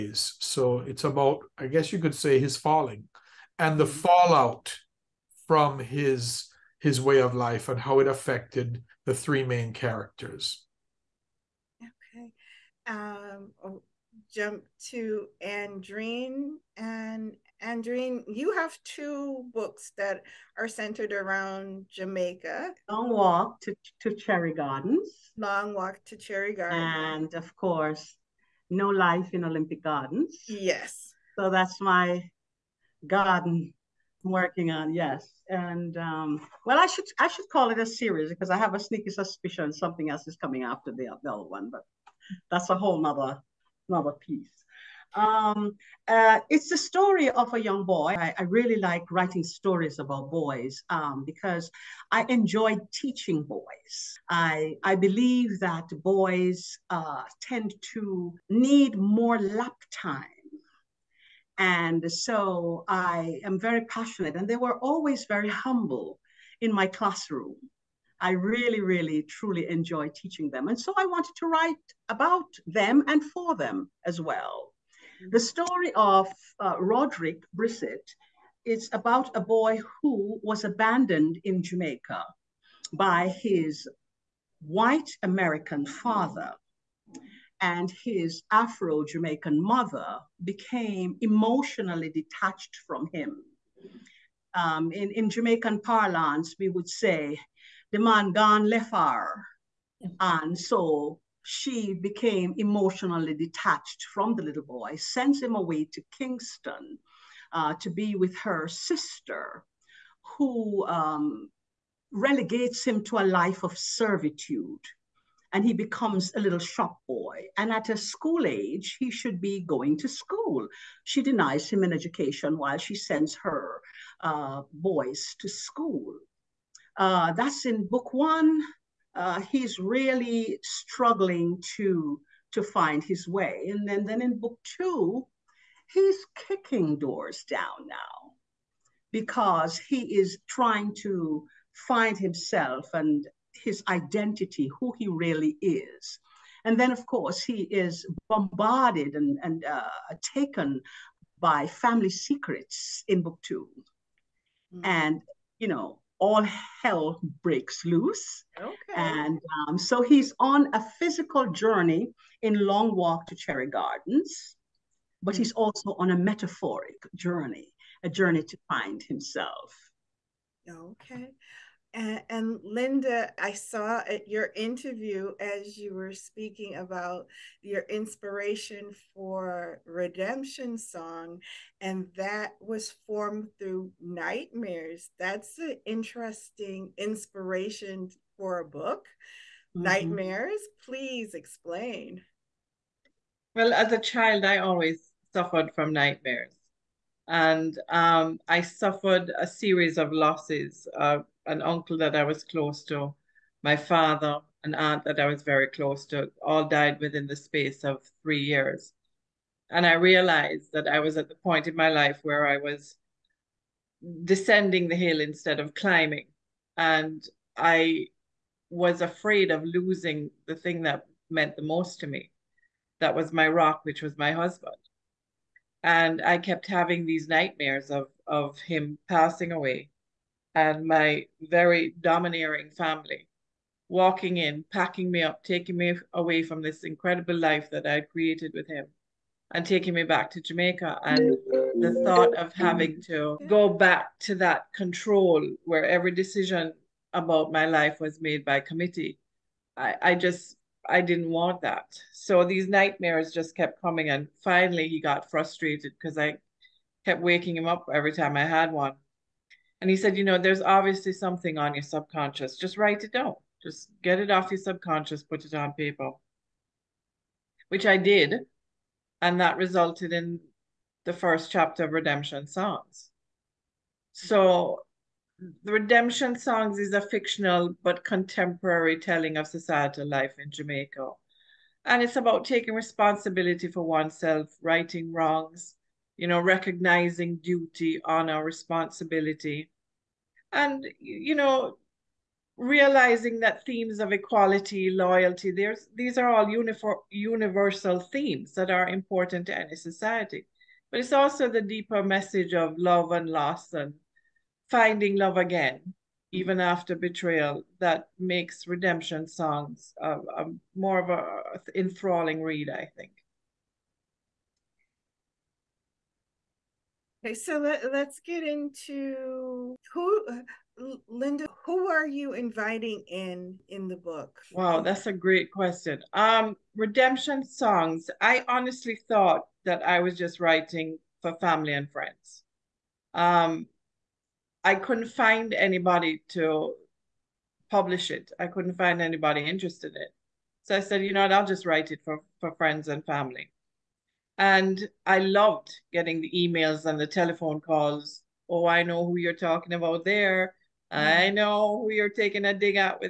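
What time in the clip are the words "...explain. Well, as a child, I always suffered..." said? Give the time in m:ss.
3:11.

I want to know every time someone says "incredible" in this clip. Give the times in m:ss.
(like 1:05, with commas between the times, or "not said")
3:56.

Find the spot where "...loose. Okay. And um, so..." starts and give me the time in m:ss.
2:37.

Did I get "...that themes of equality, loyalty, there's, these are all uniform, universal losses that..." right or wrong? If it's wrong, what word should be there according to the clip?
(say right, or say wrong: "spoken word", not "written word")
wrong: "themes", not "losses".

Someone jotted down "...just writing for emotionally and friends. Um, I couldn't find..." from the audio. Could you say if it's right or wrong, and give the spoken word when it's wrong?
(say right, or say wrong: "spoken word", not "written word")
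wrong: "family", not "emotionally".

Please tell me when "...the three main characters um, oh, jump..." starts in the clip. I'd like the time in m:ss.
0:09.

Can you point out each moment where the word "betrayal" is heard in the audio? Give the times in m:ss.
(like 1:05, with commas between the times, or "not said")
5:06.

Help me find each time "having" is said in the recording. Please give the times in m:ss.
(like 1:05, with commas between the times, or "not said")
3:46, 4:02.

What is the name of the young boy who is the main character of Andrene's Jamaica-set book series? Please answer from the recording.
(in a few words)
Roderick Brissett.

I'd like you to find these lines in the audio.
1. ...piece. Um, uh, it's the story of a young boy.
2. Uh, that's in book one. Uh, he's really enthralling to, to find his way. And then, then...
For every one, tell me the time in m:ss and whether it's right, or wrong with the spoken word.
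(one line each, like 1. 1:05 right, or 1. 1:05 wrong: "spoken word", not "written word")
1. 0:44 right
2. 2:06 wrong: "struggling", not "enthralling".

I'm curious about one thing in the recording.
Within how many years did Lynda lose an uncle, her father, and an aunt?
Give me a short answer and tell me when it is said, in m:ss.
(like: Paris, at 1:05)
3, at 3:28.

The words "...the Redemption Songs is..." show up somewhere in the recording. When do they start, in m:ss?
4:35.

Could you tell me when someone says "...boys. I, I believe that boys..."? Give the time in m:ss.
0:53.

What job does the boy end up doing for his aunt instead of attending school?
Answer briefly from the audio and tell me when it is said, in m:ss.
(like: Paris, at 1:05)
shop boy, at 1:56.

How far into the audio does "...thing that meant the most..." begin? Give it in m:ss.
3:40.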